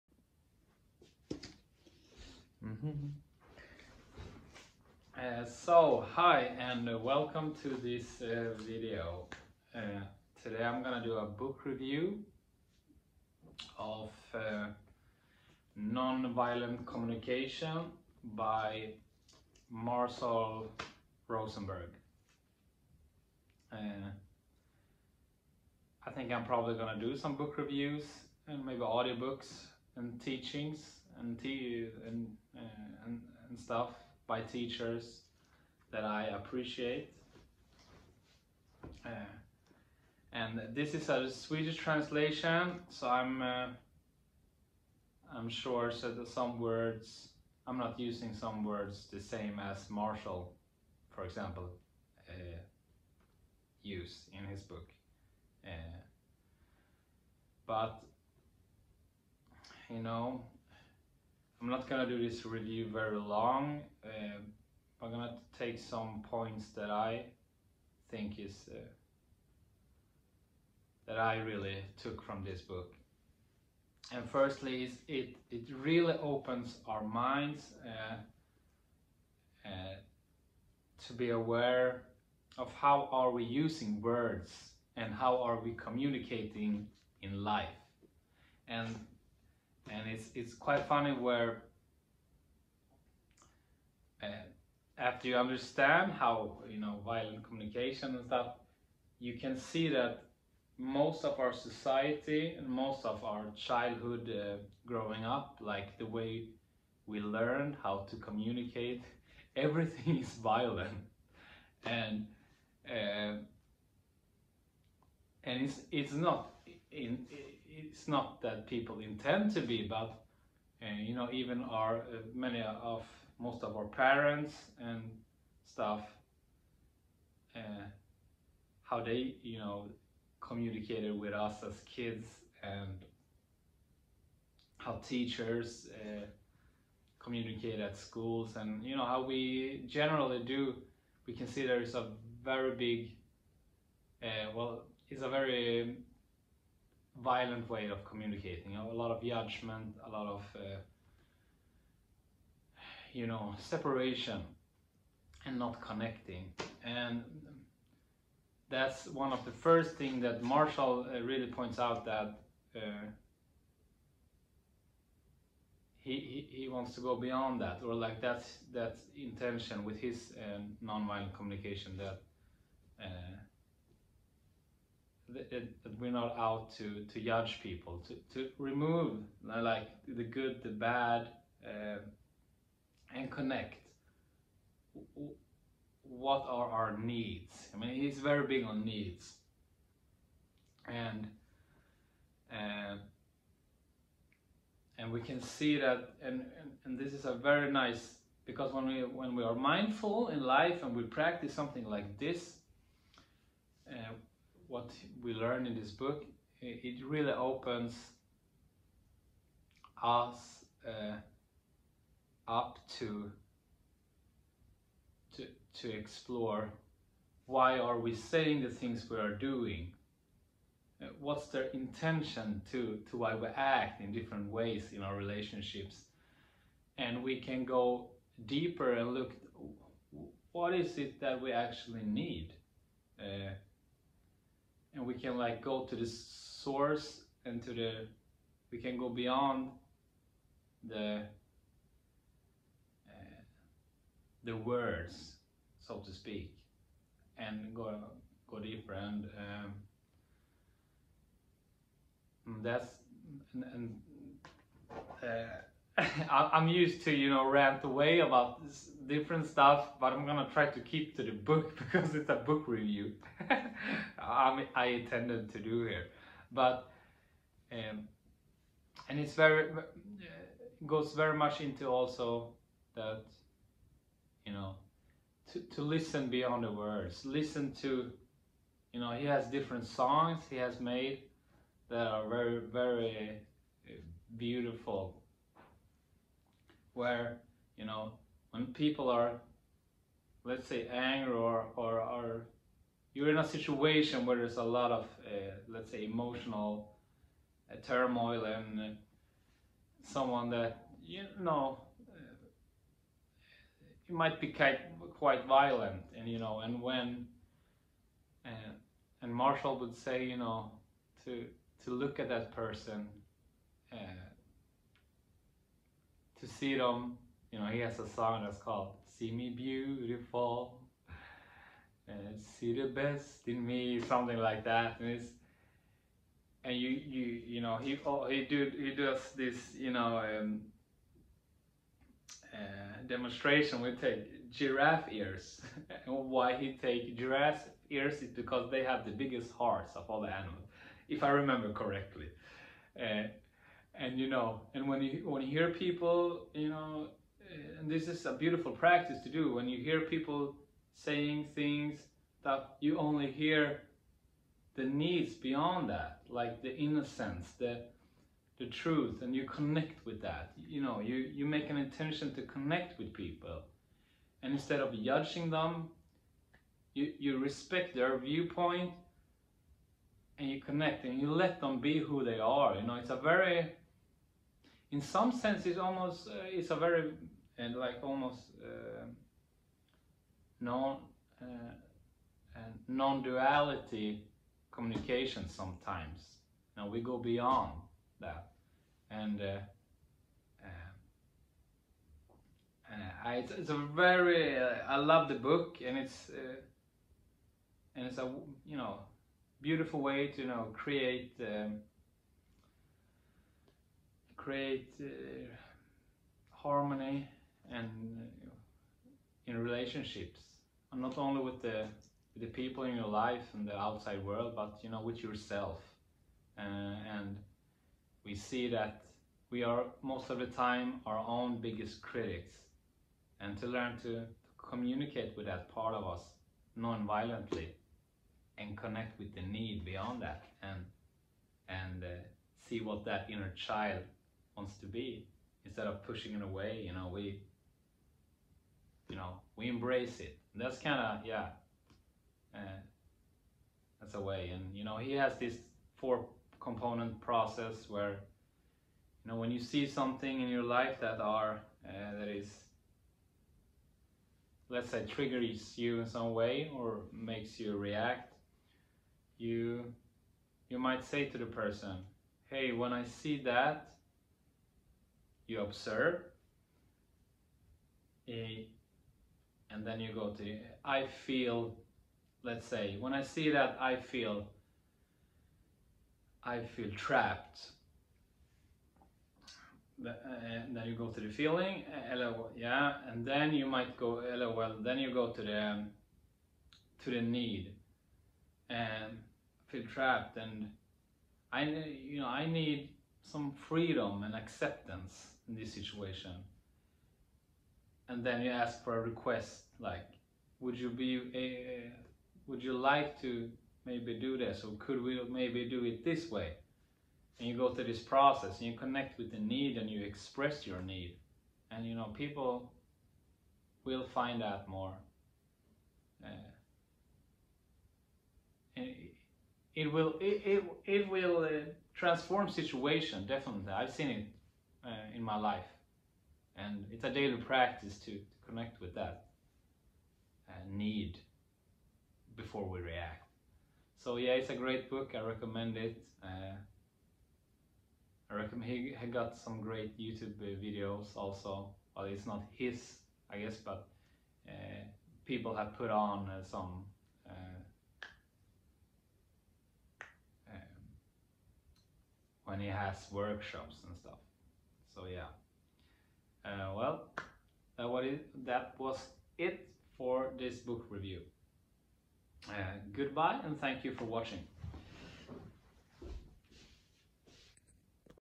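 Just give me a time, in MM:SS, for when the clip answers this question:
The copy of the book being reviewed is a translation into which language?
00:41.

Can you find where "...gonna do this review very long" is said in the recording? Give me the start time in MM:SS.
01:01.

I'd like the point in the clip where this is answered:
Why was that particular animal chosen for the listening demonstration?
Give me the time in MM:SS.
05:39.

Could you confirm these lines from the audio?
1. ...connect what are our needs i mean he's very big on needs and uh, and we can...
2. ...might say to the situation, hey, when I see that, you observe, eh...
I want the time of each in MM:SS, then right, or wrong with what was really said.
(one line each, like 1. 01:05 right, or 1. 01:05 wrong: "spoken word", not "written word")
1. 03:03 right
2. 07:40 wrong: "person", not "situation".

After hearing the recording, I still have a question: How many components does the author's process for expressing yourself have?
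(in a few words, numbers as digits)
4.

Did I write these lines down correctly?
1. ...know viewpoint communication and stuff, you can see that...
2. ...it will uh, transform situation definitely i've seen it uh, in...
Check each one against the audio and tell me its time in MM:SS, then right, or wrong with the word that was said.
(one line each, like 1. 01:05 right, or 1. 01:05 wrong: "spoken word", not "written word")
1. 01:36 wrong: "violent", not "viewpoint"
2. 08:40 right.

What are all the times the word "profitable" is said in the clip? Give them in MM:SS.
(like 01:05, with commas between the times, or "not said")
not said.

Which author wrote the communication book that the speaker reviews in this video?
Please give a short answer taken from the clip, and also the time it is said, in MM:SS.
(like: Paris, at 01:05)
Marshall Rosenberg, at 00:19.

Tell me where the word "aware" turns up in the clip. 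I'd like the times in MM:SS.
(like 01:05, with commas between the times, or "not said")
01:21.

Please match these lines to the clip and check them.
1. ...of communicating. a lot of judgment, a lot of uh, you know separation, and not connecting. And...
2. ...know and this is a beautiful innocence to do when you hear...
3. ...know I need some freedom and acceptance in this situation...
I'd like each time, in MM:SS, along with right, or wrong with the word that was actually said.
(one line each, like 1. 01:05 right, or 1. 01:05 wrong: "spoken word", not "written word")
1. 02:27 right
2. 05:46 wrong: "practice", not "innocence"
3. 08:12 right.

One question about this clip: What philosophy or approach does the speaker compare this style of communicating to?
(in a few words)
Non-duality.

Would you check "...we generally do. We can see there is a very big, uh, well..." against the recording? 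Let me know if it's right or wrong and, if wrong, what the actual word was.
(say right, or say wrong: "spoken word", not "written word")
right.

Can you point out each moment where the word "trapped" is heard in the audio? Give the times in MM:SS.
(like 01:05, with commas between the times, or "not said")
07:56, 08:09.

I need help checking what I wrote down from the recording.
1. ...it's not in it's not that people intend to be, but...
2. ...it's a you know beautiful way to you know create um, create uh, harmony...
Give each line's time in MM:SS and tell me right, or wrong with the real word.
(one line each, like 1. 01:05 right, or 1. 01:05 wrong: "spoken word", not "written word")
1. 01:55 right
2. 06:38 right.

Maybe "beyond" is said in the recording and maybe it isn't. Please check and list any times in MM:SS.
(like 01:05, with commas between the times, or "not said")
02:47, 03:59, 04:36, 05:55, 06:27, 07:09.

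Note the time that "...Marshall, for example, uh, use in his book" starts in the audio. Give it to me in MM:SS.
00:49.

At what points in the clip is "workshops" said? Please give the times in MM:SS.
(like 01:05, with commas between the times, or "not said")
09:13.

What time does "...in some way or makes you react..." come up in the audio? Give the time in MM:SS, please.
07:35.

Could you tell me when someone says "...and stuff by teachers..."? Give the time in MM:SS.
00:33.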